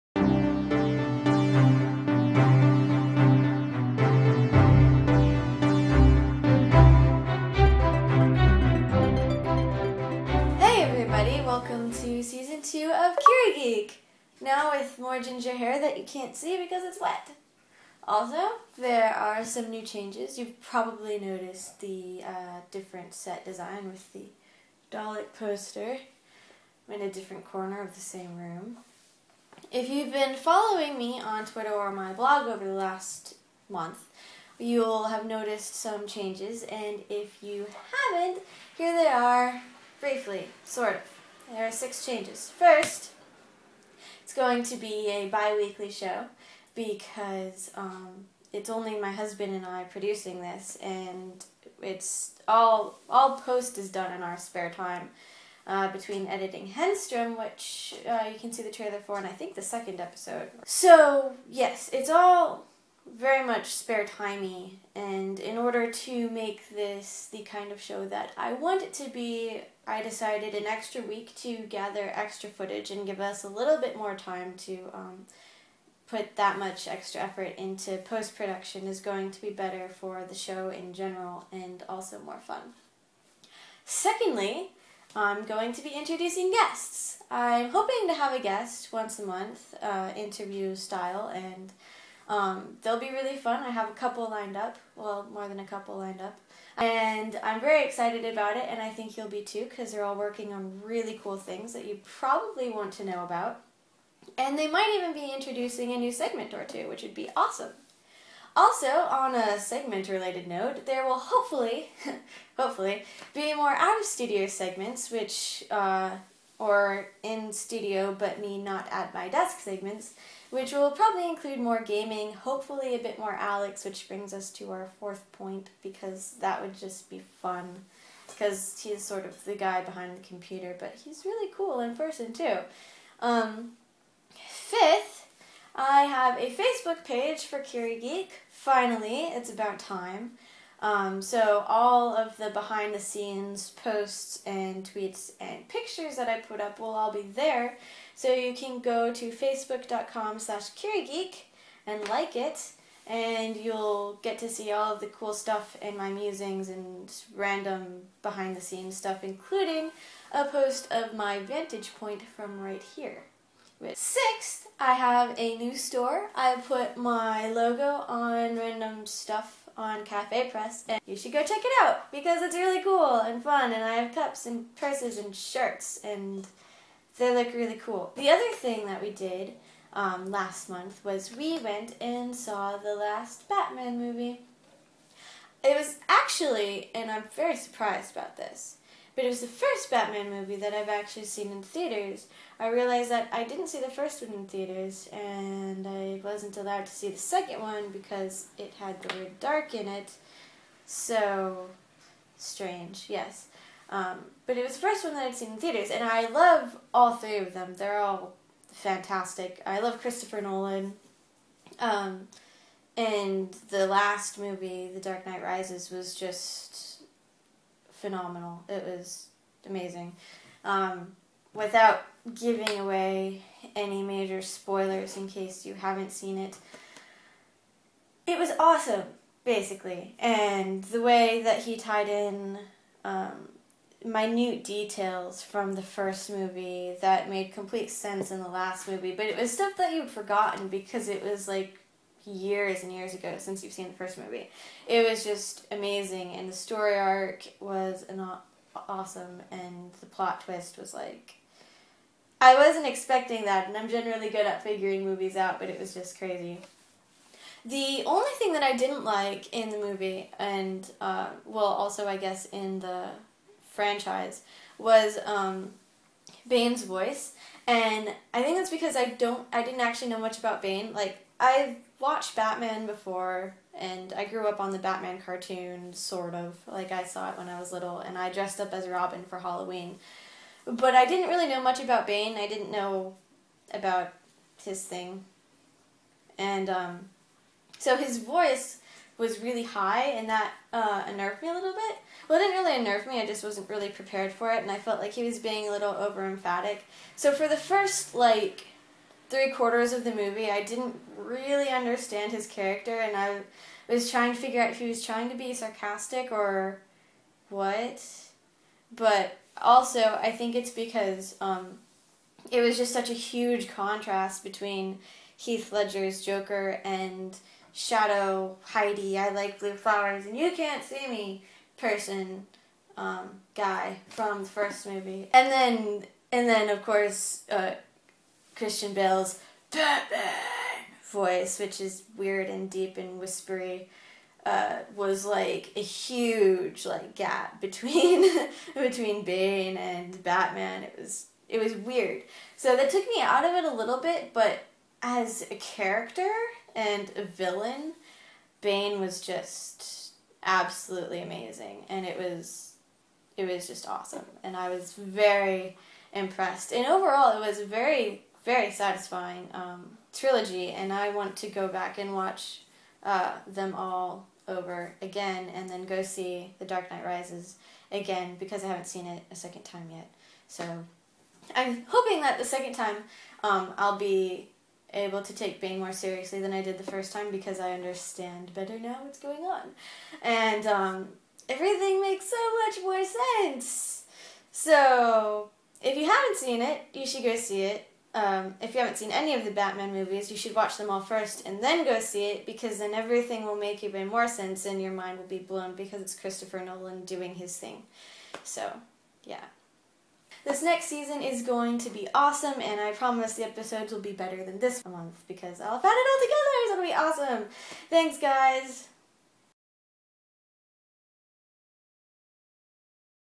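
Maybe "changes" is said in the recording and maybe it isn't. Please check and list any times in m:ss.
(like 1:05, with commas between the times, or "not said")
0:19, 0:36, 0:42.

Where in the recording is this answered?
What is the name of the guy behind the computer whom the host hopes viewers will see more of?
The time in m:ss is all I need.
2:03.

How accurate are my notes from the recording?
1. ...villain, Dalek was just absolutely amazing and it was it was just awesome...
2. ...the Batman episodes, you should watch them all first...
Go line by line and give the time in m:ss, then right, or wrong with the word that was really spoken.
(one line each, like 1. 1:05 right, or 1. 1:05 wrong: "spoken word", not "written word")
1. 5:47 wrong: "Bane", not "Dalek"
2. 6:29 wrong: "movies", not "episodes".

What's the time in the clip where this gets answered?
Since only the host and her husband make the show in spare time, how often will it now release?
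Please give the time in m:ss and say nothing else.
0:45.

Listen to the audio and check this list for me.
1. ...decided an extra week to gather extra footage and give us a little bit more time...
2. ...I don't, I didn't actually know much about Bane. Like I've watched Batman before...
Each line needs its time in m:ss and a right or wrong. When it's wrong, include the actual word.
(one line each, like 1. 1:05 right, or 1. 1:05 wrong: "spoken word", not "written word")
1. 1:10 right
2. 4:28 right.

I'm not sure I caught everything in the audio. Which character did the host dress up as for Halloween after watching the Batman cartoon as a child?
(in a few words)
Robin.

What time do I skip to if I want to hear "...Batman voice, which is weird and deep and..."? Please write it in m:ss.
5:29.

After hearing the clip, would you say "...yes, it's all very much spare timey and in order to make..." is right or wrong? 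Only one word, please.
right.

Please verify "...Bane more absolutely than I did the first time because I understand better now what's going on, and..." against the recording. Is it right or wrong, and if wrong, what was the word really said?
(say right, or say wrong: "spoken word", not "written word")
wrong: "seriously", not "absolutely".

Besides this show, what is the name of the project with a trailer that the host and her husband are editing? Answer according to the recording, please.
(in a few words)
Henstrom.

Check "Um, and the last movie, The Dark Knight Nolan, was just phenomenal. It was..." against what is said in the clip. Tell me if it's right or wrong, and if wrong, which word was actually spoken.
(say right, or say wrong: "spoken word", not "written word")
wrong: "Rises", not "Nolan".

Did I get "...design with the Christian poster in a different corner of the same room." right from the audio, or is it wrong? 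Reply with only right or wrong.
wrong.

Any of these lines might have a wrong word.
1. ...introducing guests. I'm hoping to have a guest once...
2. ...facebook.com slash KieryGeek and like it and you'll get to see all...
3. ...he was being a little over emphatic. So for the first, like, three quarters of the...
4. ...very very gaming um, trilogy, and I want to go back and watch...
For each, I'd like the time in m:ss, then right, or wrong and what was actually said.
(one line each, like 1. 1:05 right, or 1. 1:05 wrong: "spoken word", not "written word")
1. 1:25 right
2. 2:29 right
3. 4:55 right
4. 5:57 wrong: "satisfying", not "gaming".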